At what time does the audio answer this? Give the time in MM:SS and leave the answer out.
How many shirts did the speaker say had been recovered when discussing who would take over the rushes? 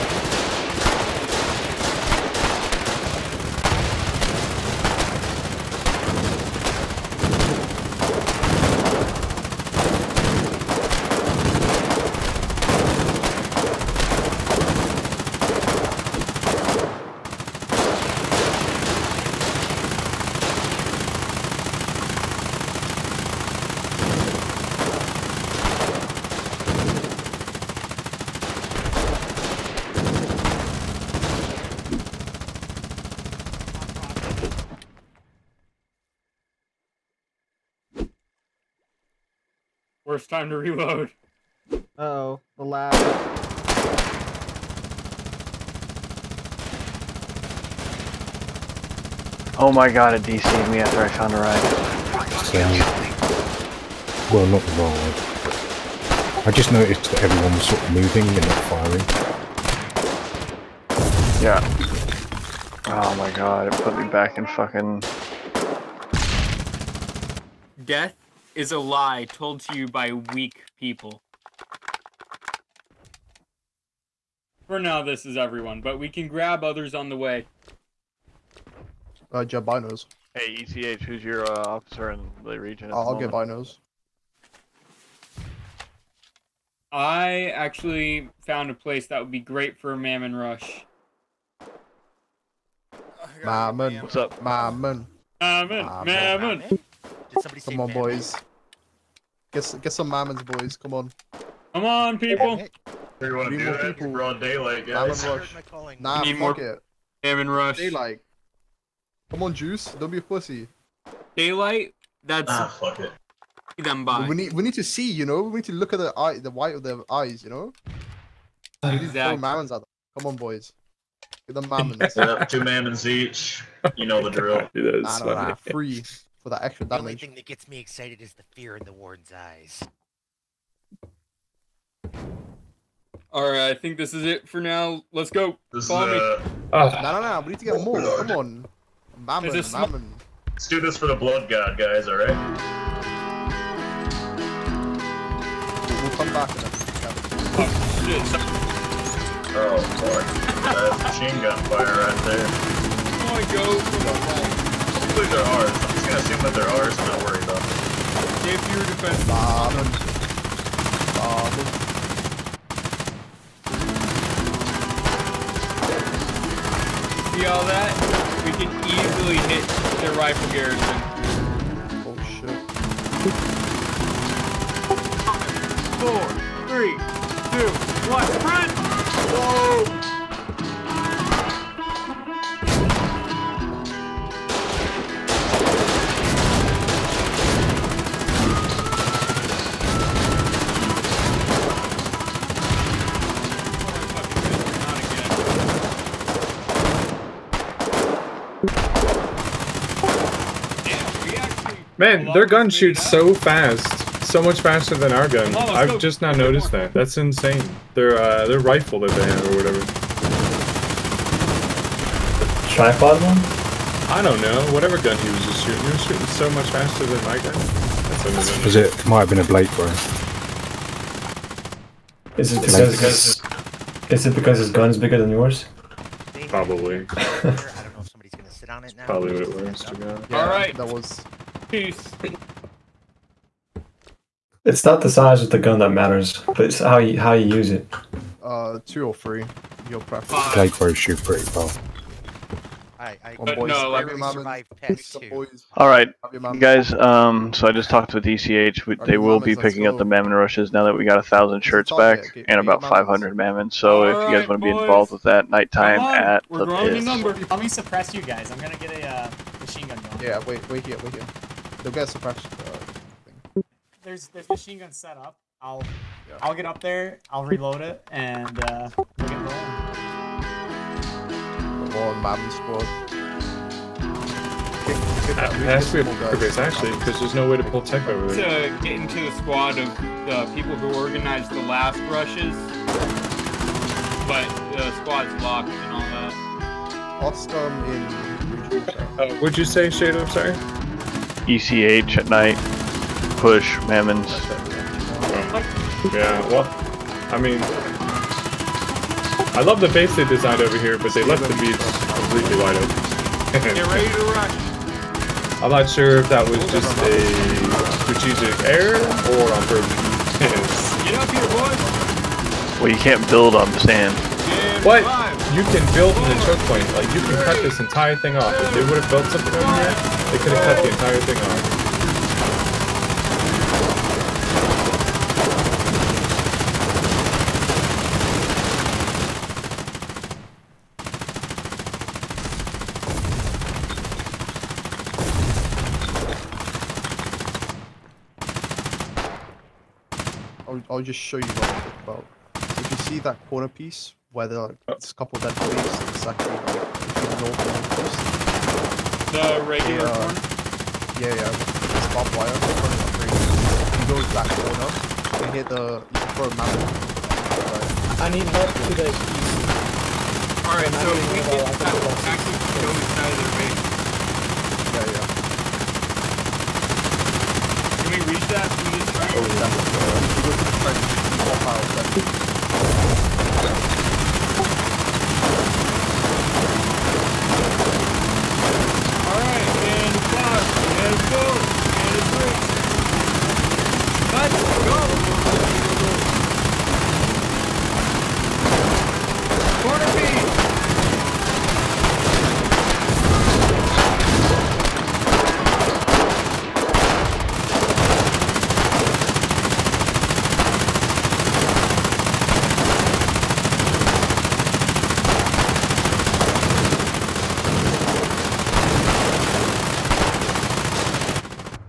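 04:11.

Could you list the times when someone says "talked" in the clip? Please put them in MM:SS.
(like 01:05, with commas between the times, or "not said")
04:07.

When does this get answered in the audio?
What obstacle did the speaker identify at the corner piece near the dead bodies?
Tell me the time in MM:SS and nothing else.
05:52.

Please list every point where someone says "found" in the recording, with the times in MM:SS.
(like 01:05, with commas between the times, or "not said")
00:51, 01:28.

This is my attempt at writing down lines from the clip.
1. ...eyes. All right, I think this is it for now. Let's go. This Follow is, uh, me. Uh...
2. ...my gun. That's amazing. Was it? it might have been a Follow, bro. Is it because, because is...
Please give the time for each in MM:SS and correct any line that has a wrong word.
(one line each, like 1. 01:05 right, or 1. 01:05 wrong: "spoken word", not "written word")
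1. 02:09 right
2. 03:37 wrong: "Blake", not "Follow".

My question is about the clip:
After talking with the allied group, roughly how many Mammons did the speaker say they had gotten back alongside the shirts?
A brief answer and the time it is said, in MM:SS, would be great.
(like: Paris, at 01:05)
500, at 04:12.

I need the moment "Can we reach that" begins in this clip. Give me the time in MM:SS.
06:08.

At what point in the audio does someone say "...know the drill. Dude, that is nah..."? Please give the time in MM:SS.
02:04.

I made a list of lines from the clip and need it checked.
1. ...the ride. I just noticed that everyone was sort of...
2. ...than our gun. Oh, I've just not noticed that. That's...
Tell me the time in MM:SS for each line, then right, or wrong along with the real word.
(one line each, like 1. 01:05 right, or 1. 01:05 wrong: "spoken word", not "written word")
1. 00:54 right
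2. 03:24 right.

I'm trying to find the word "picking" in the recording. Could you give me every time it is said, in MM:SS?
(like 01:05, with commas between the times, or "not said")
04:09.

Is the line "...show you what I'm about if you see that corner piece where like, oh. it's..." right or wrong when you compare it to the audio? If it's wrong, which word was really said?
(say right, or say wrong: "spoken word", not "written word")
right.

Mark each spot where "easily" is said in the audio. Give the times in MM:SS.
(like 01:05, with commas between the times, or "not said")
02:48.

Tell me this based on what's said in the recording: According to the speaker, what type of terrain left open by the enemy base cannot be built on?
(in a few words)
Sand.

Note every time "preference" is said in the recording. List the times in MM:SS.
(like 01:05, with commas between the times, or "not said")
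04:00.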